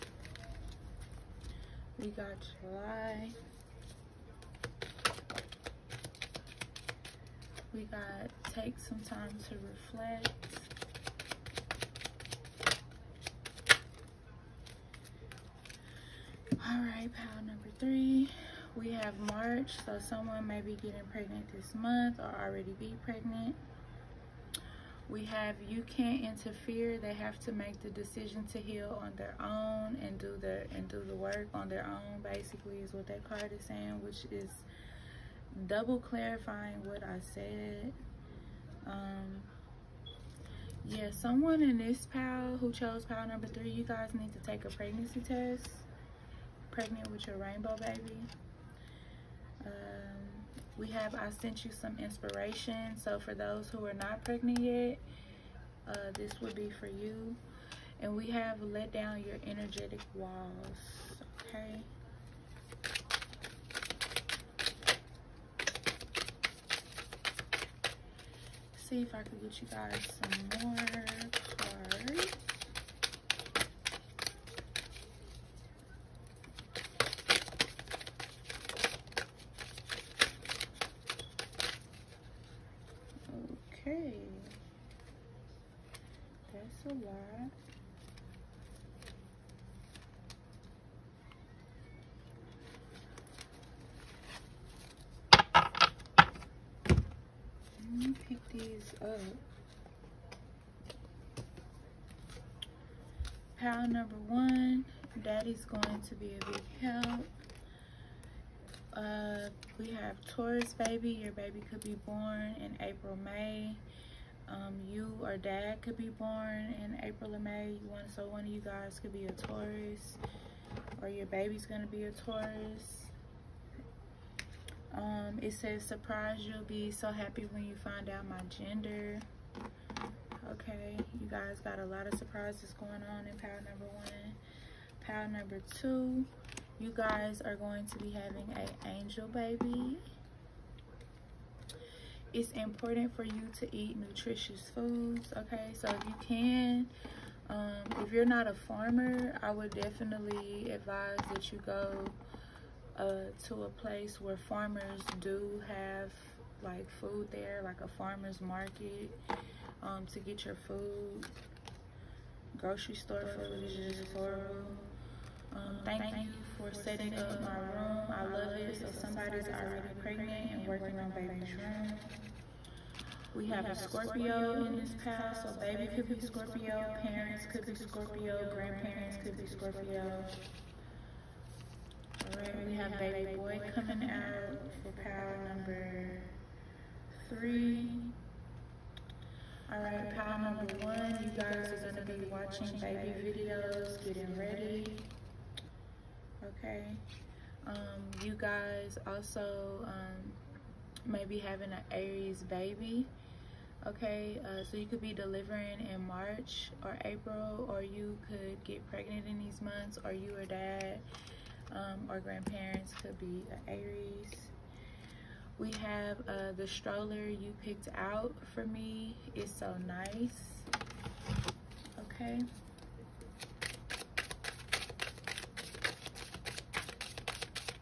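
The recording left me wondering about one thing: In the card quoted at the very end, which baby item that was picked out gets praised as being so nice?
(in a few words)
Stroller.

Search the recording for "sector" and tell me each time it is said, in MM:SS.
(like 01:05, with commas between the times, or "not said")
not said.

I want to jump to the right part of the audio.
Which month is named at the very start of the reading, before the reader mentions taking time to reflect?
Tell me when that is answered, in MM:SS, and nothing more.
00:02.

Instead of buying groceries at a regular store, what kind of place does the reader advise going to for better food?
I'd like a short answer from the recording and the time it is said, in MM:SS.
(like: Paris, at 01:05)
Farmer's market, at 02:37.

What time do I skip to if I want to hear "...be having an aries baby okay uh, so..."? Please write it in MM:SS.
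03:21.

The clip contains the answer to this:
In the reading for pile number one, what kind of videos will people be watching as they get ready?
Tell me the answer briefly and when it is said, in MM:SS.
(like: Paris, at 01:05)
Baby videos, at 03:12.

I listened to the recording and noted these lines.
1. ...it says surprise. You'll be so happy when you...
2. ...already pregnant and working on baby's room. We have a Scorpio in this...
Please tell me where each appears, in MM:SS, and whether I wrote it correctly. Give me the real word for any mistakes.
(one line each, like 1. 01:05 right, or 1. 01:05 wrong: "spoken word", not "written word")
1. 02:05 right
2. 02:49 right.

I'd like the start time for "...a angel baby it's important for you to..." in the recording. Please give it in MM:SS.
02:18.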